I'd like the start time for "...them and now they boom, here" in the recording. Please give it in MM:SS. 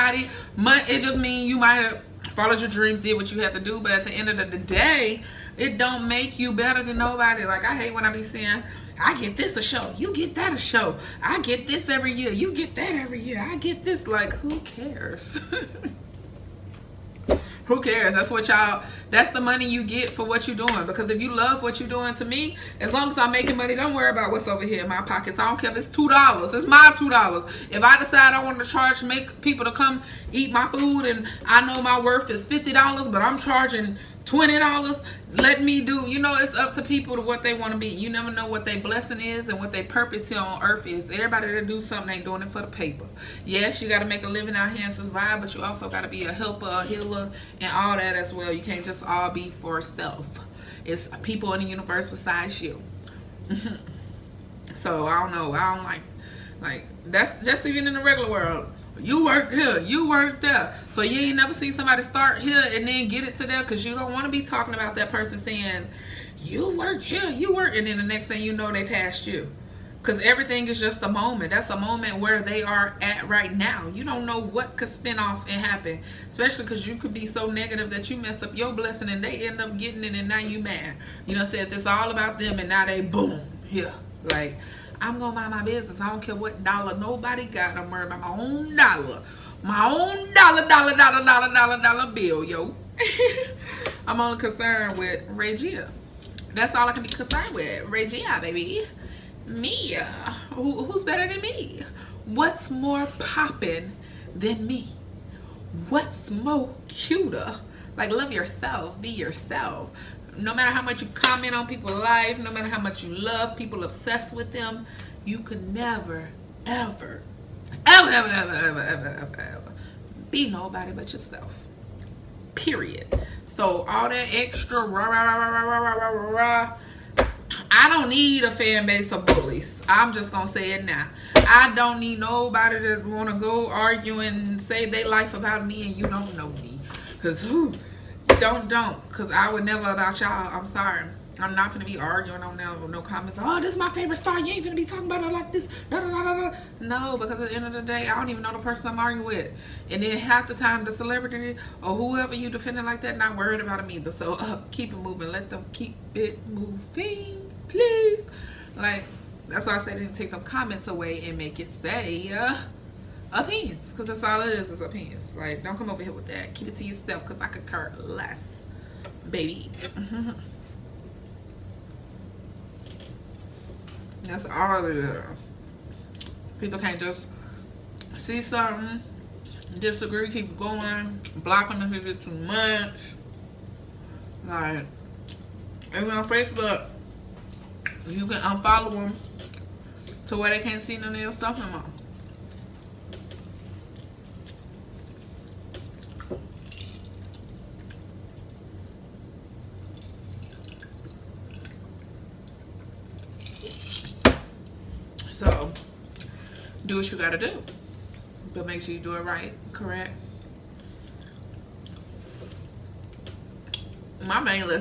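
01:22.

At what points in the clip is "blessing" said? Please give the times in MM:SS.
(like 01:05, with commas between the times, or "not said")
00:38, 01:18.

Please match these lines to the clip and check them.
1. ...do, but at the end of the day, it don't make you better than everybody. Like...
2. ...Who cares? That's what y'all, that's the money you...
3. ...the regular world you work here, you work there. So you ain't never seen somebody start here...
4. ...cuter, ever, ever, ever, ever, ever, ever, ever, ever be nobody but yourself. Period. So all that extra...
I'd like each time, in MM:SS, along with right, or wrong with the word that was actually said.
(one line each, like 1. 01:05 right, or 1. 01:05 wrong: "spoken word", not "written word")
1. 00:03 wrong: "nobody", not "everybody"
2. 00:17 right
3. 00:57 right
4. 01:55 wrong: "never", not "cuter".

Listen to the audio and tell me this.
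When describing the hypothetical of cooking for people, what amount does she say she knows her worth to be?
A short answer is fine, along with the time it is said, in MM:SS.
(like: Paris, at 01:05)
$50, at 00:32.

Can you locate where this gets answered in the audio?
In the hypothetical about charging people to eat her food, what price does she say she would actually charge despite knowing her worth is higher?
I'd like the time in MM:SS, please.
00:34.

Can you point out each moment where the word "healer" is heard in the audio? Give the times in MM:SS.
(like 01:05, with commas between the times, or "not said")
00:46.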